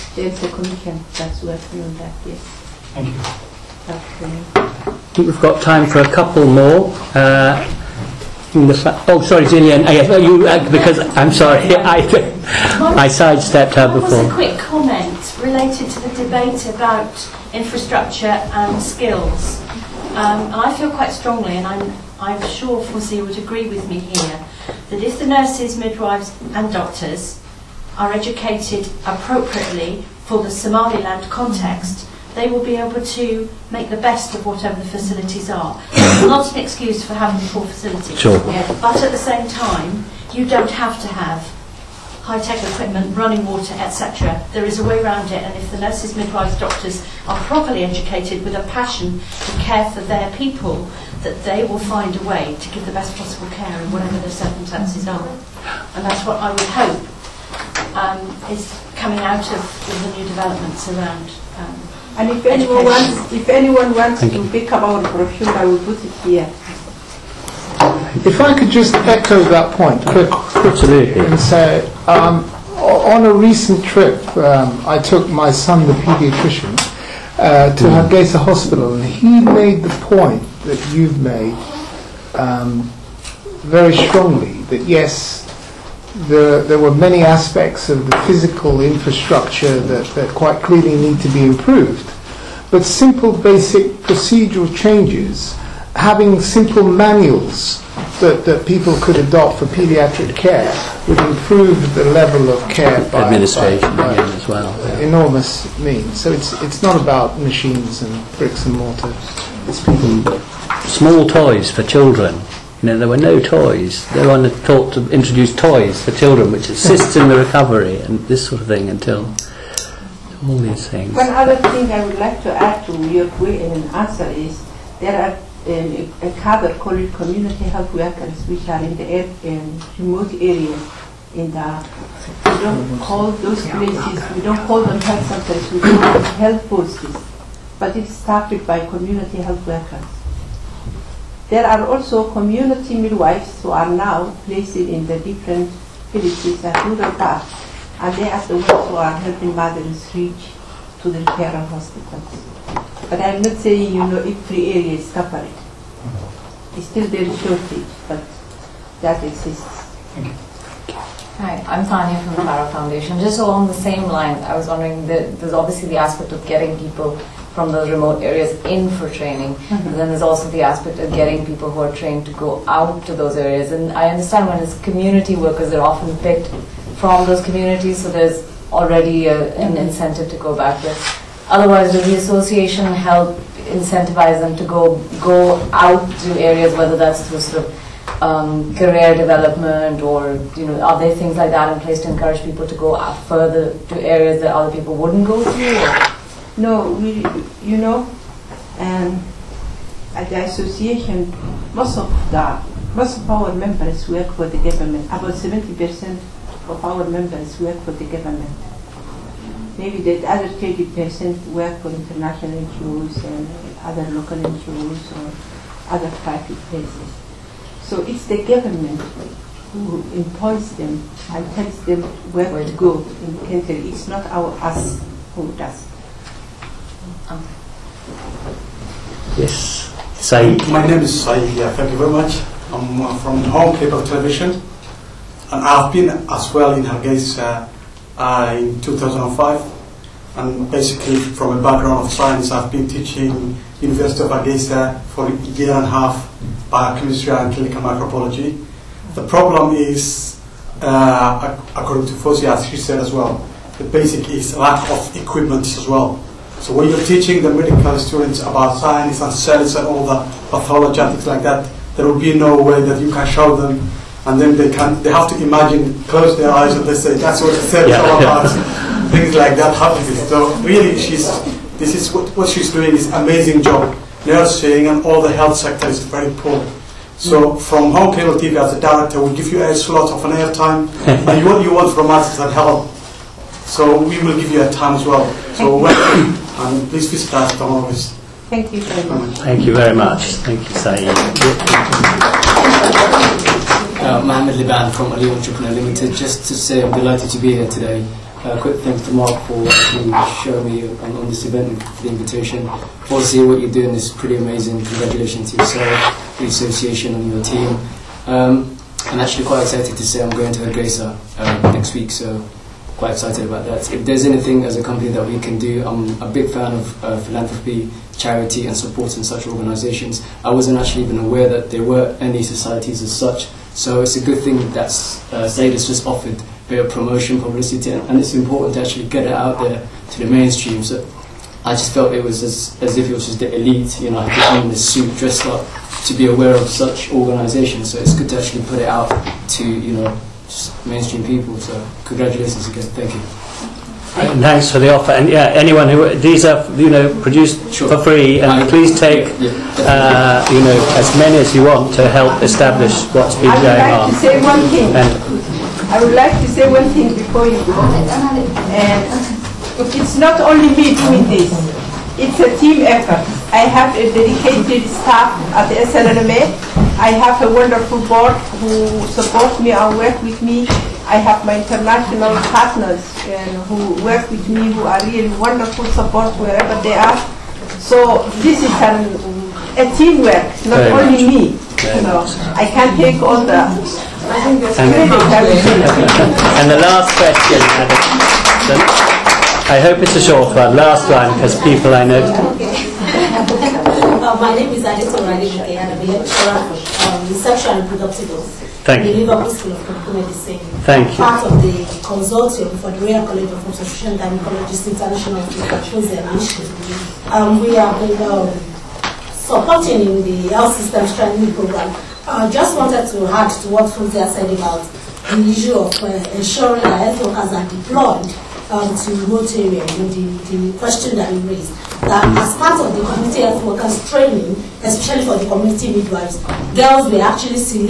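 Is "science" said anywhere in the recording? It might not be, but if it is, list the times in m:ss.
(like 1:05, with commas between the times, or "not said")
4:02, 4:18.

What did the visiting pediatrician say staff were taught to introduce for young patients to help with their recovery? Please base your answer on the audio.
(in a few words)
Small toys.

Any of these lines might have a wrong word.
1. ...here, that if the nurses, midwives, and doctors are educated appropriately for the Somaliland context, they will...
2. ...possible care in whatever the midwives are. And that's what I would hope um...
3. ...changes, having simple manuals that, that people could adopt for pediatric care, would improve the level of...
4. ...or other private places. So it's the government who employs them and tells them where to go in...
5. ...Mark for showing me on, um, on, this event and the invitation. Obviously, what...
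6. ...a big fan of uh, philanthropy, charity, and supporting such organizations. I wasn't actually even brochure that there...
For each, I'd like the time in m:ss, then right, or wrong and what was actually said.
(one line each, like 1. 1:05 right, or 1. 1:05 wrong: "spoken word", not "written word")
1. 0:23 right
2. 0:53 wrong: "circumstances", not "midwives"
3. 1:34 right
4. 3:35 right
5. 4:59 right
6. 5:16 wrong: "aware", not "brochure".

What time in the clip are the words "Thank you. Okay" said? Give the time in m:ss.
0:02.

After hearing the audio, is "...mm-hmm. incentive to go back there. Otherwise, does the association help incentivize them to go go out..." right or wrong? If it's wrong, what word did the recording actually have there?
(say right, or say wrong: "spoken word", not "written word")
right.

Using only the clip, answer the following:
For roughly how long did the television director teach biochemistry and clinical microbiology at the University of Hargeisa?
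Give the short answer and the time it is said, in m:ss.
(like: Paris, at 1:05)
A year and a half, at 4:05.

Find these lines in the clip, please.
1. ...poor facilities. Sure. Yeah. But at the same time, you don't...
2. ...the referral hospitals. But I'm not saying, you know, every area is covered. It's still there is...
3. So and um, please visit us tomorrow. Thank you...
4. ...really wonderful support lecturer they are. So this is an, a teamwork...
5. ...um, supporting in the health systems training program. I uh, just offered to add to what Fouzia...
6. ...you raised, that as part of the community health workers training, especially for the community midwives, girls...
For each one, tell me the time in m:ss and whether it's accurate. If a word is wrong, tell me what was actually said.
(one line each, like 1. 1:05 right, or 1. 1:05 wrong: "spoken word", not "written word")
1. 0:37 right
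2. 2:31 right
3. 4:45 right
4. 6:15 wrong: "wherever", not "lecturer"
5. 6:47 wrong: "wanted", not "offered"
6. 7:01 right.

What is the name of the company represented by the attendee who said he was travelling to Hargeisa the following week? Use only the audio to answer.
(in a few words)
Ali Entrepreneur Limited.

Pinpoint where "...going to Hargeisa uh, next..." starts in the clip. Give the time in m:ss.
5:10.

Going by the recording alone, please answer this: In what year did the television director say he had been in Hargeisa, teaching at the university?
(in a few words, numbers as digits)
2005.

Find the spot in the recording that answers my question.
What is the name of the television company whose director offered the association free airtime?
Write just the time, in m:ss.
3:53.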